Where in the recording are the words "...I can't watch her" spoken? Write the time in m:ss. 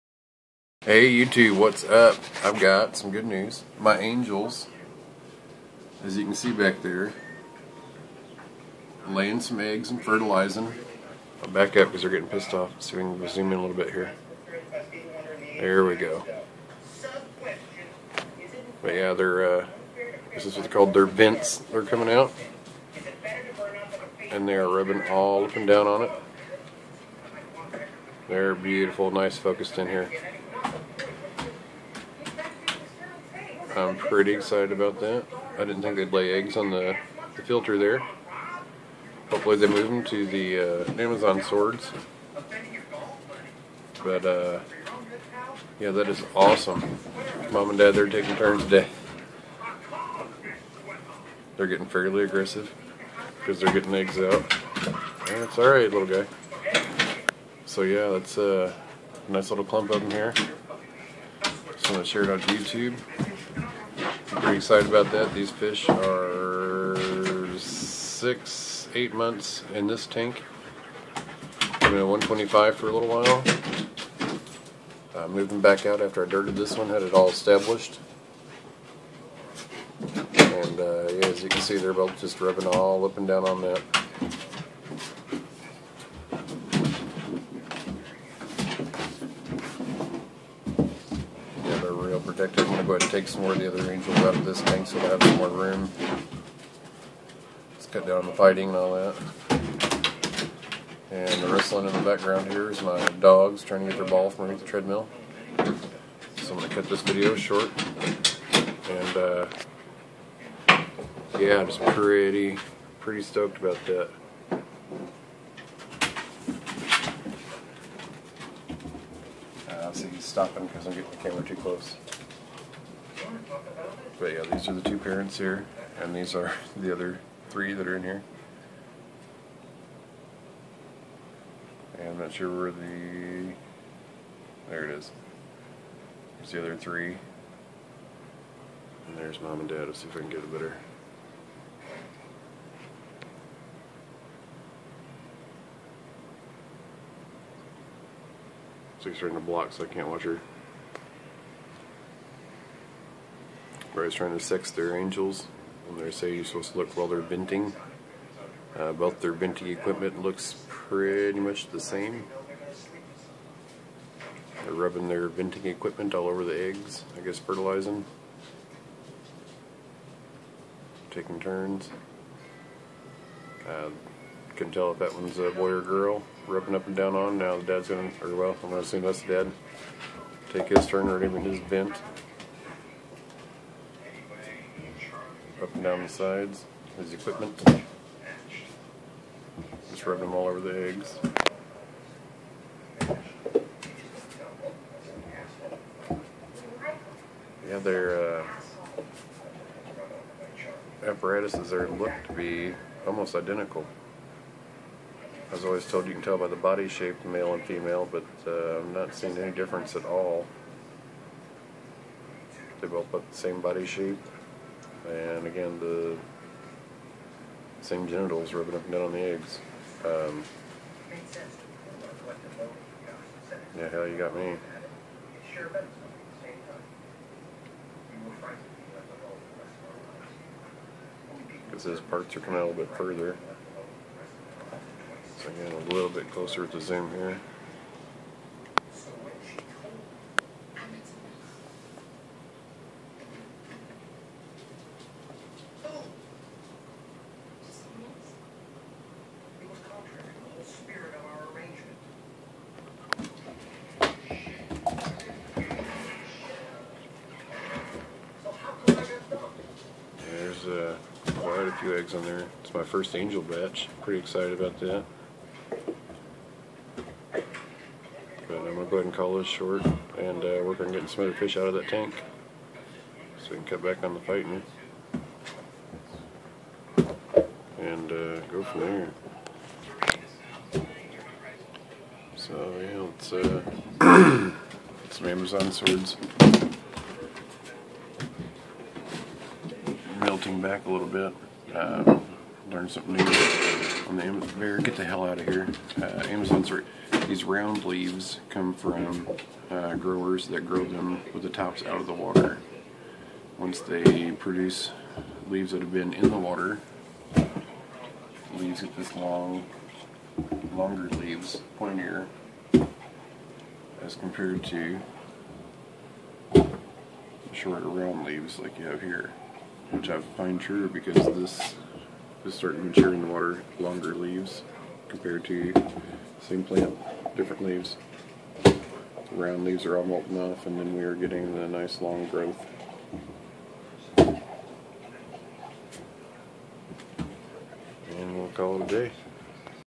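2:29.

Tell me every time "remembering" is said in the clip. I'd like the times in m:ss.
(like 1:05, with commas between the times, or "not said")
not said.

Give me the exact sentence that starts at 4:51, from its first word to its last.
Uh, learn something new on the Amazon.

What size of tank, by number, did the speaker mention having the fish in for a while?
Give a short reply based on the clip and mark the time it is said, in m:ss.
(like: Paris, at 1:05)
125, at 1:12.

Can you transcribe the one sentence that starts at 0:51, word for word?
They're getting fairly aggressive because they're getting eggs out.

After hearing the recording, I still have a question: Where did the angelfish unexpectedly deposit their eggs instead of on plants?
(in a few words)
The filter.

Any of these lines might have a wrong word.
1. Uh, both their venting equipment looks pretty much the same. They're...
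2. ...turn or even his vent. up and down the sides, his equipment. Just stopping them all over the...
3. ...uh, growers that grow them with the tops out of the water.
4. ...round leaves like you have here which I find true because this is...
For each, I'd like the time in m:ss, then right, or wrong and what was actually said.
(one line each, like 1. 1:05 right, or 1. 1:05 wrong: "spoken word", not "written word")
1. 2:38 right
2. 3:00 wrong: "rubbing", not "stopping"
3. 4:59 right
4. 5:17 right.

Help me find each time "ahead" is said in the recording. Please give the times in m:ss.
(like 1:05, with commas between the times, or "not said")
1:32, 4:28.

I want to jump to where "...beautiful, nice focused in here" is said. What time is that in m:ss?
0:28.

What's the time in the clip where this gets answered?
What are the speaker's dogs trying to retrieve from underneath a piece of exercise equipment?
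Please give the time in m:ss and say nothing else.
1:43.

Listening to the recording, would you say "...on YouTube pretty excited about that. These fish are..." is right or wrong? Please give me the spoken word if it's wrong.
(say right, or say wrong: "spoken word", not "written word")
right.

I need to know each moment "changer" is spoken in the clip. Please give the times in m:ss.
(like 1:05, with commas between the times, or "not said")
not said.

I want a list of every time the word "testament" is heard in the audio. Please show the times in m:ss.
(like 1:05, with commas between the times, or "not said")
not said.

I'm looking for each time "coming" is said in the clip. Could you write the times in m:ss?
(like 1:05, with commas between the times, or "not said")
0:21, 3:52.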